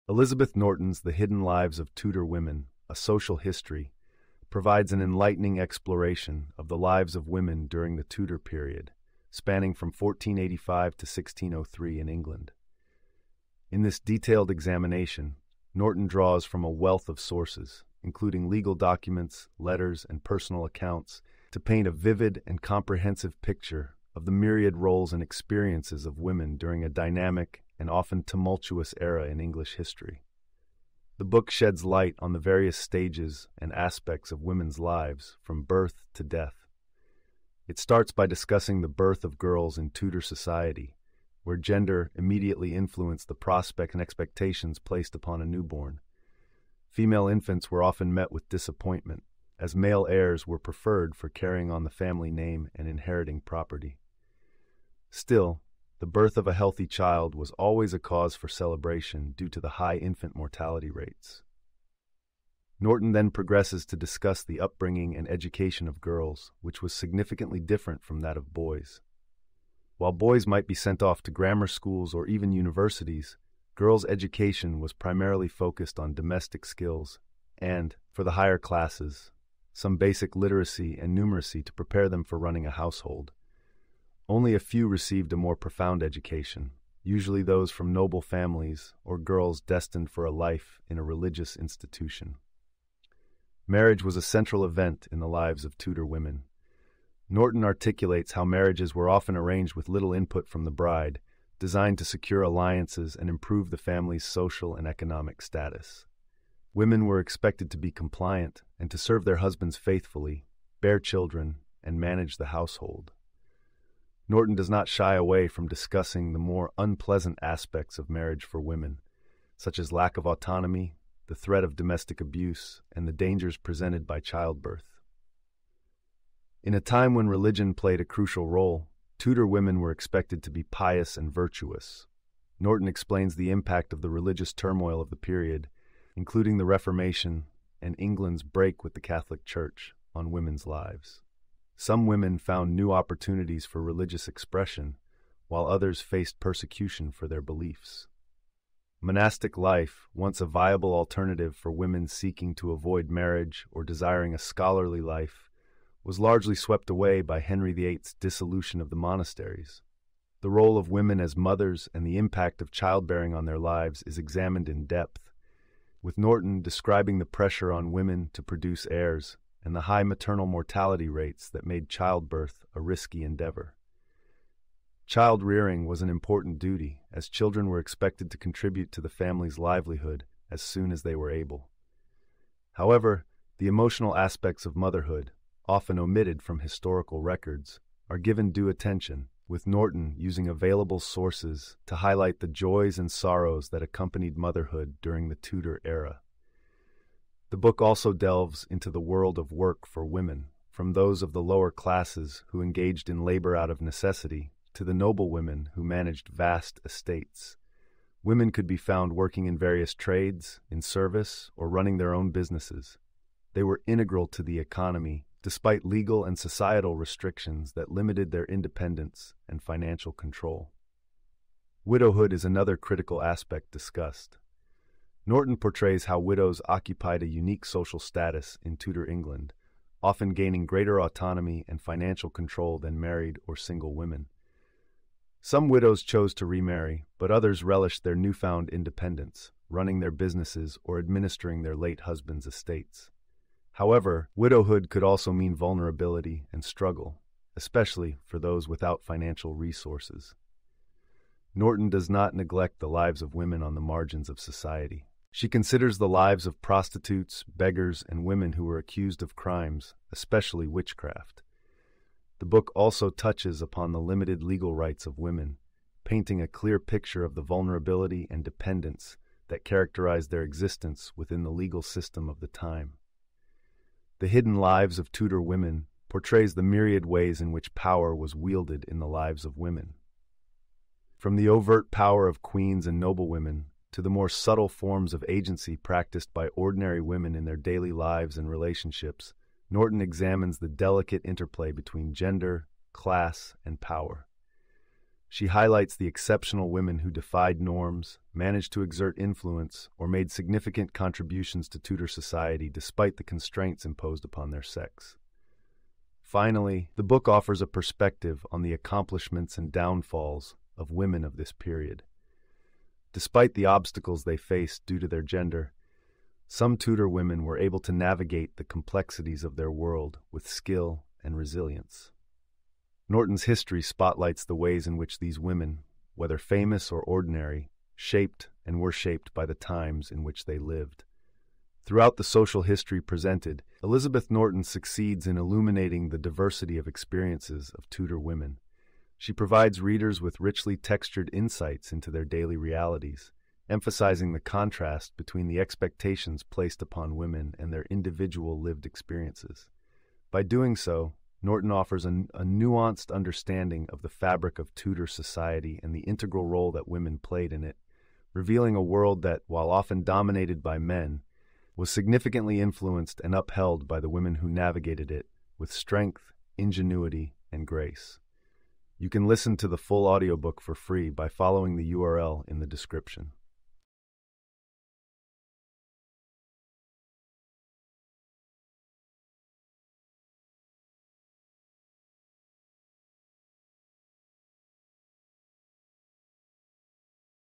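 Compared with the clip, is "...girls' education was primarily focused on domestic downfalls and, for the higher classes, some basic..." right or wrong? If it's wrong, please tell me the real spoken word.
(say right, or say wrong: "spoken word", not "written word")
wrong: "skills", not "downfalls".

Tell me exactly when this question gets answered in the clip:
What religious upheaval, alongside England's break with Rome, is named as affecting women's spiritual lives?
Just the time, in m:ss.
2:16.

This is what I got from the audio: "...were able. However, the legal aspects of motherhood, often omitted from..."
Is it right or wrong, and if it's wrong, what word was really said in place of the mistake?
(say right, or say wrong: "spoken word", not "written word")
wrong: "emotional", not "legal".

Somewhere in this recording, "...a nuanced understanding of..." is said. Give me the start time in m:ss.
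5:52.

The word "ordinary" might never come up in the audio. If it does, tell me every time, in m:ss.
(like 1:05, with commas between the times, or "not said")
4:46, 5:27.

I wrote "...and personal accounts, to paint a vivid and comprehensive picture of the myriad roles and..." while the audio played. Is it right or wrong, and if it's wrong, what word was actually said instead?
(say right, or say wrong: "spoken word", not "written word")
right.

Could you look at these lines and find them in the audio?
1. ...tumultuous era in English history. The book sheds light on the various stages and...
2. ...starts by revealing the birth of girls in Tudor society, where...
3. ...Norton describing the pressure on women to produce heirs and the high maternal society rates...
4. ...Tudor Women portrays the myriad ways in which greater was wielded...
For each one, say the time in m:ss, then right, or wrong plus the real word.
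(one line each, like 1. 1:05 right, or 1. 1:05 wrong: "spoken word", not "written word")
1. 0:28 right
2. 0:37 wrong: "discussing", not "revealing"
3. 2:46 wrong: "mortality", not "society"
4. 4:35 wrong: "power", not "greater".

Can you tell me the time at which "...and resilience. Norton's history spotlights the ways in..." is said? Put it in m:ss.
5:21.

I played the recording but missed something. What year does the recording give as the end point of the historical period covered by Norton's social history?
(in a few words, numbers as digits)
1603.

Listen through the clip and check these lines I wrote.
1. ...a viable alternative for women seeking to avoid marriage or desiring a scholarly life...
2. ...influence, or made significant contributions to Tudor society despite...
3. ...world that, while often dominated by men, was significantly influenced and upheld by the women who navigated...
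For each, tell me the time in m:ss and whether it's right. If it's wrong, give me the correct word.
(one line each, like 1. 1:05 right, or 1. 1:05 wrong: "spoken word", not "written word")
1. 2:30 right
2. 4:59 right
3. 5:58 right.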